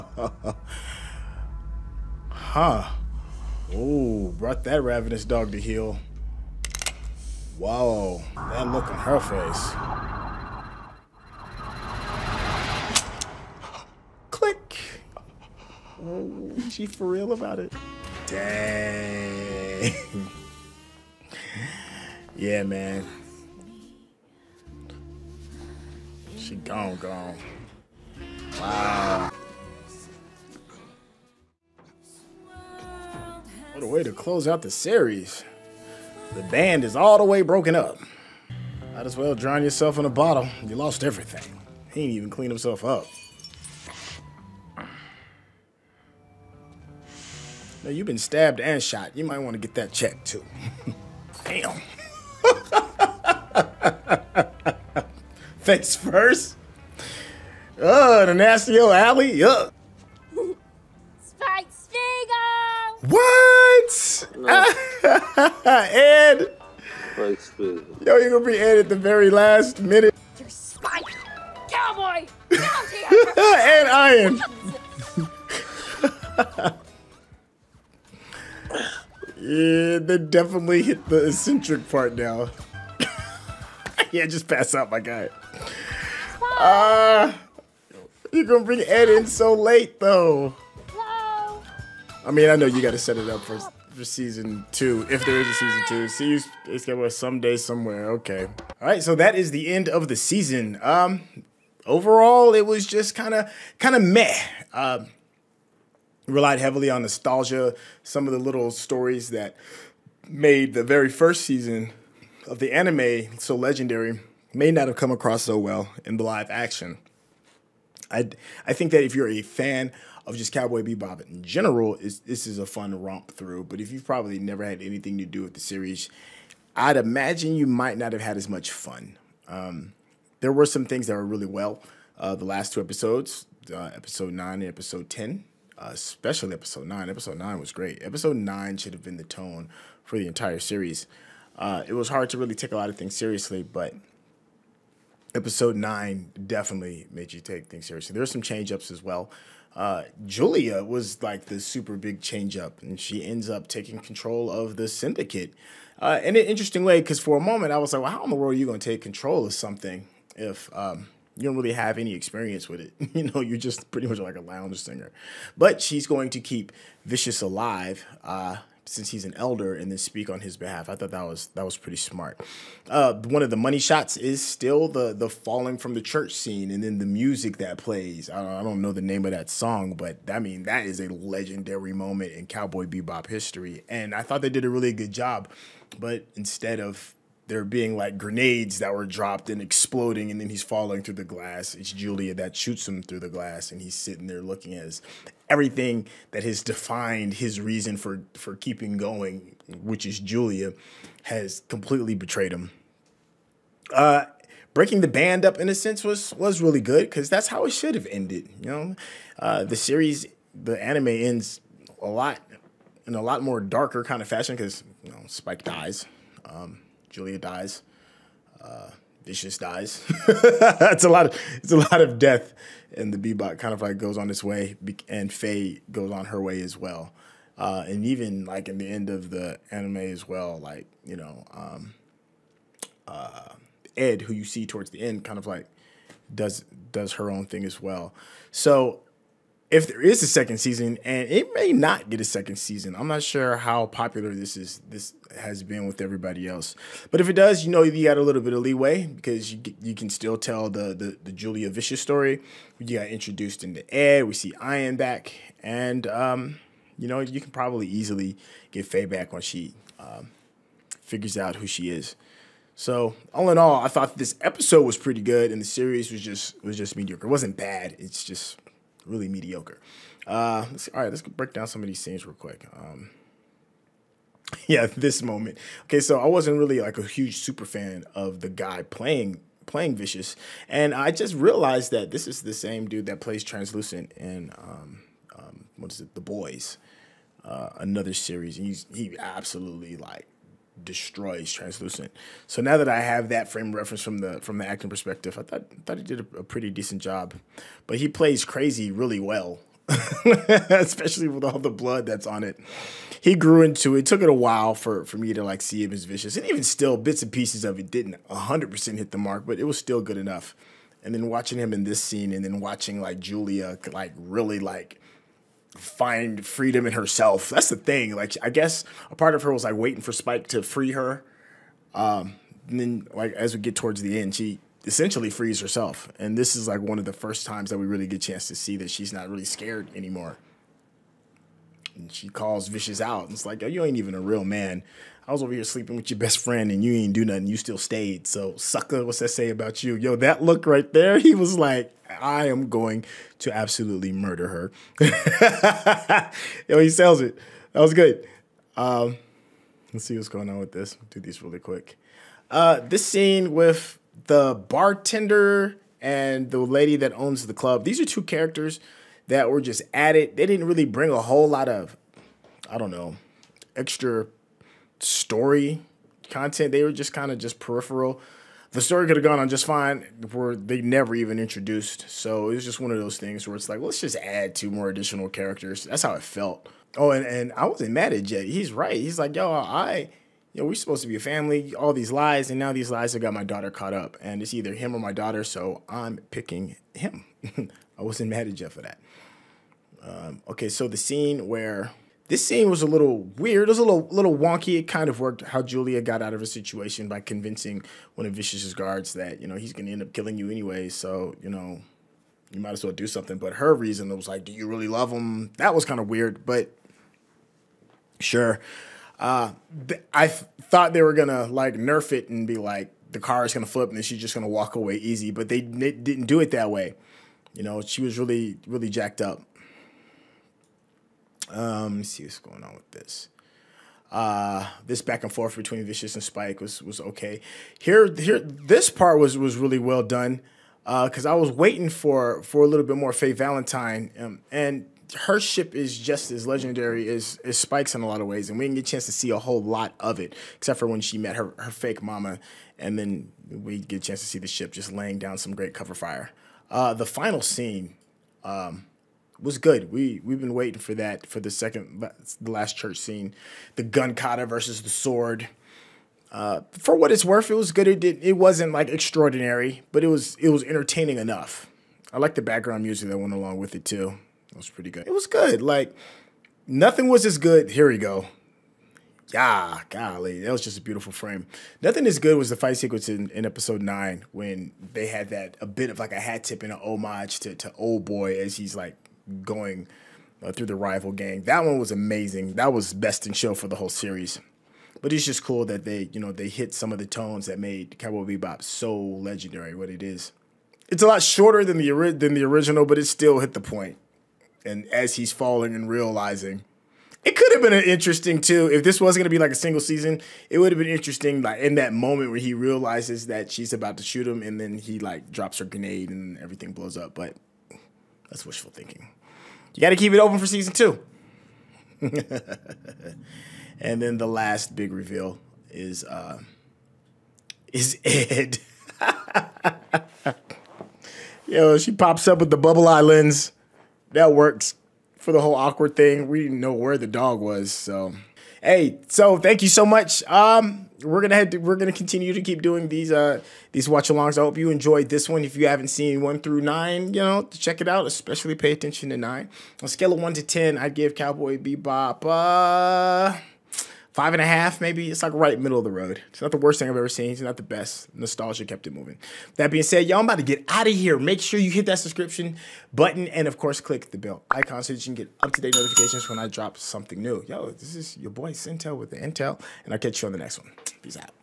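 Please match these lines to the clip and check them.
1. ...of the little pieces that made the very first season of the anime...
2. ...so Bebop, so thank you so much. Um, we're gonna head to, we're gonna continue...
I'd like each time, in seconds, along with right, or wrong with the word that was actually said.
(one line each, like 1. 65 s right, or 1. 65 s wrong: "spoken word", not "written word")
1. 108 s wrong: "stories", not "pieces"
2. 527 s wrong: "Hey", not "Bebop".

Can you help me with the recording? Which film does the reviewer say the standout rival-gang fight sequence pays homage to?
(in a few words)
Oldboy.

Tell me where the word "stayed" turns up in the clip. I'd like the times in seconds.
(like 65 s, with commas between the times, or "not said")
337 s.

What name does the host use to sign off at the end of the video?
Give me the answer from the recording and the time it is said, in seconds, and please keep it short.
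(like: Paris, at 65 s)
Syntell, at 558 s.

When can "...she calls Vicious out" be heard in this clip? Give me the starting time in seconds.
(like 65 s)
332 s.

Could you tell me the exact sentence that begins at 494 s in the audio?
And as he's falling and realizing, it could have been an interesting too.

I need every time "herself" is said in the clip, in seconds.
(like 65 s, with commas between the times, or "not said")
316 s, 325 s.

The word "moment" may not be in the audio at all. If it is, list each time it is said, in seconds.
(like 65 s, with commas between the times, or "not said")
157 s, 181 s, 275 s, 501 s.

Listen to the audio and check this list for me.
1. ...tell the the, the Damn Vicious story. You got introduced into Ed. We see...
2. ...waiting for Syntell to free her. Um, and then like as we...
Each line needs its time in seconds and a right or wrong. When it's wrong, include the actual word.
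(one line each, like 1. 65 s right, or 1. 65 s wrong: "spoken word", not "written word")
1. 250 s wrong: "Julia", not "Damn"
2. 319 s wrong: "Spike", not "Syntell".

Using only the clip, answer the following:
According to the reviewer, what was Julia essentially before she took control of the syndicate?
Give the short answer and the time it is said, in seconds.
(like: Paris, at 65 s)
A lounge singer, at 164 s.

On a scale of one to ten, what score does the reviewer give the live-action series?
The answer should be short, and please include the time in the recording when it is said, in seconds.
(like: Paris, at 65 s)
5.5, at 544 s.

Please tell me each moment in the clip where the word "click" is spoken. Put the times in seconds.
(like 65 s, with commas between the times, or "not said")
14 s, 553 s.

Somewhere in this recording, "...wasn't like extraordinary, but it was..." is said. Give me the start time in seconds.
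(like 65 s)
458 s.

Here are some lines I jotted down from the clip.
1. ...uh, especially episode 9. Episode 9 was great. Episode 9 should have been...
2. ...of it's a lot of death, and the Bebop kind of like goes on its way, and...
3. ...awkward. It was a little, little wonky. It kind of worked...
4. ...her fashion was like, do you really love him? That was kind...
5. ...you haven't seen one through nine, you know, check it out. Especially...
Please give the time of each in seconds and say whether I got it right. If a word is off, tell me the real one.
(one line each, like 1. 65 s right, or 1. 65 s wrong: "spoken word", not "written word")
1. 135 s right
2. 221 s right
3. 393 s wrong: "weird", not "awkward"
4. 403 s wrong: "reason", not "fashion"
5. 535 s right.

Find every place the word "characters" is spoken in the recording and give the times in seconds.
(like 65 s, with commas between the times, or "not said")
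358 s, 375 s.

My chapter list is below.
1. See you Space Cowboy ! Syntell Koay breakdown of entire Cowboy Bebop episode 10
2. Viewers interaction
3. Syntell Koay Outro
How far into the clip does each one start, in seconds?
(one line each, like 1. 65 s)
1. 94 s
2. 216 s
3. 528 s.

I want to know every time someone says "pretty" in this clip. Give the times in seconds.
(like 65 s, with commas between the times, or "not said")
163 s, 171 s, 264 s, 296 s, 464 s.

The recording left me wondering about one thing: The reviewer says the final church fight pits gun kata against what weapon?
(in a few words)
Sword.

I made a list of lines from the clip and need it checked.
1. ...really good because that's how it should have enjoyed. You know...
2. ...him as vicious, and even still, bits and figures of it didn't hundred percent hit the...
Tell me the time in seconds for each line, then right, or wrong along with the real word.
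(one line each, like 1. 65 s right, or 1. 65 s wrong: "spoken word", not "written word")
1. 206 s wrong: "ended", not "enjoyed"
2. 305 s wrong: "pieces", not "figures".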